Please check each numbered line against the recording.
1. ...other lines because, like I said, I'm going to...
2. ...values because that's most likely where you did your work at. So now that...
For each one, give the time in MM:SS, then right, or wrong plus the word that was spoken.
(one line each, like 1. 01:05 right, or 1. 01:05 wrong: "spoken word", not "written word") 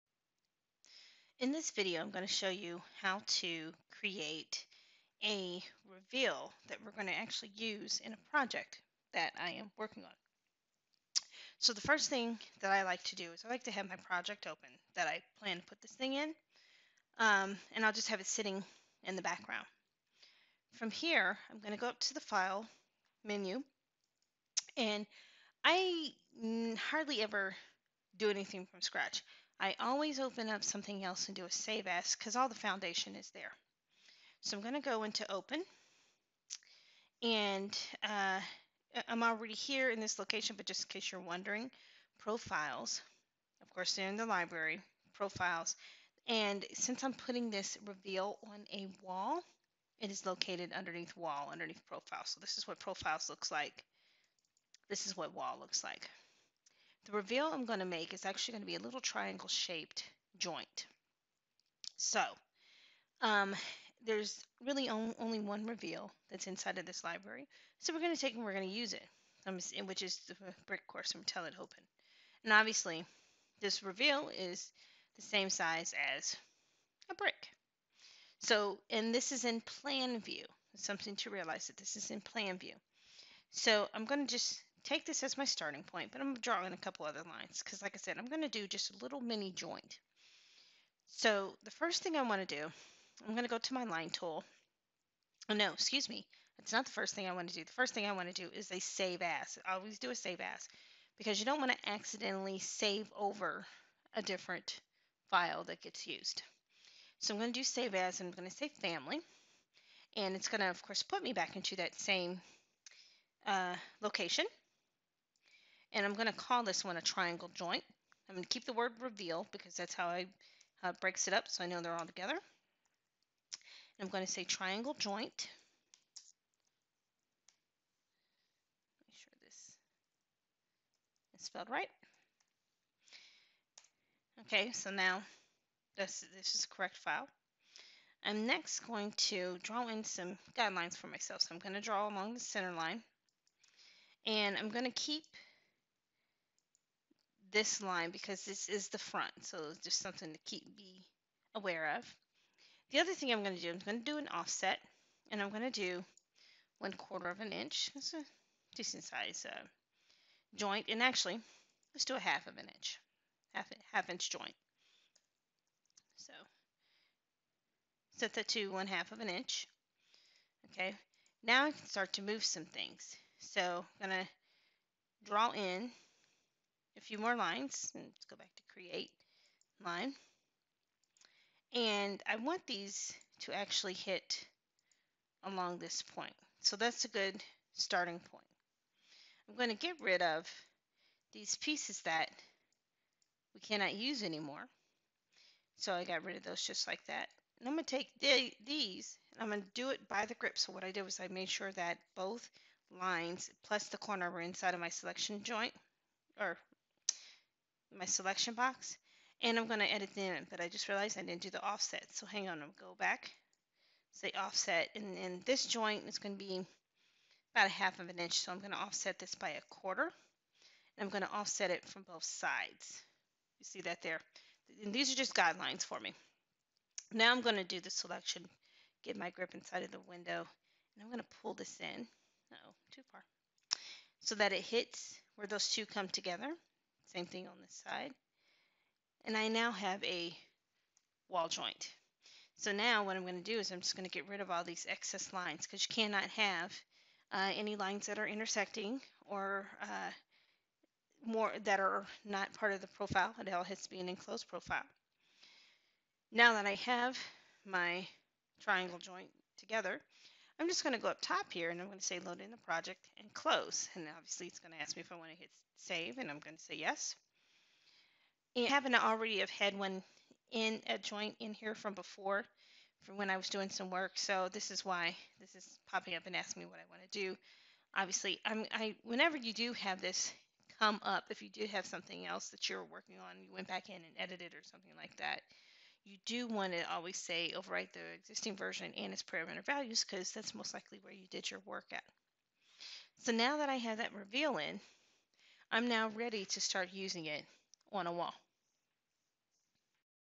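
1. 01:27 right
2. 04:49 right.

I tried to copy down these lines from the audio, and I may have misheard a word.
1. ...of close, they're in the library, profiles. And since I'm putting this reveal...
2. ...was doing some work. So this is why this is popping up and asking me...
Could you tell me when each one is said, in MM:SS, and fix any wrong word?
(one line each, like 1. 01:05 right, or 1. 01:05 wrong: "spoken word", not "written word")
1. 00:43 wrong: "course", not "close"
2. 04:33 right.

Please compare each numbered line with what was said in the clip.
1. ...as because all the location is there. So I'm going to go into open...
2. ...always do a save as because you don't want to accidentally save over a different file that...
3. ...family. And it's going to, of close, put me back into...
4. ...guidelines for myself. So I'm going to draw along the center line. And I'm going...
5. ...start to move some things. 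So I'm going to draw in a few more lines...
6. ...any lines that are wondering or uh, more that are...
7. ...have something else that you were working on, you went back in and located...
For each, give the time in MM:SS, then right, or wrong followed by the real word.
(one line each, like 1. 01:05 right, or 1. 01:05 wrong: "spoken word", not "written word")
1. 00:31 wrong: "foundation", not "location"
2. 01:39 right
3. 01:48 wrong: "course", not "close"
4. 02:20 right
5. 02:51 right
6. 04:07 wrong: "intersecting", not "wondering"
7. 04:41 wrong: "edited", not "located".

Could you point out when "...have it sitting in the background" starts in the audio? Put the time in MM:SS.
00:18.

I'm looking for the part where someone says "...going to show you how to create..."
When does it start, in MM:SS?
00:02.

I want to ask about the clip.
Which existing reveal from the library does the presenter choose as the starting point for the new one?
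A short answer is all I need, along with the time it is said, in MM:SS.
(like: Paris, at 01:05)
Brick course, at 01:10.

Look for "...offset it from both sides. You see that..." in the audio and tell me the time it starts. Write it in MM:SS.
03:41.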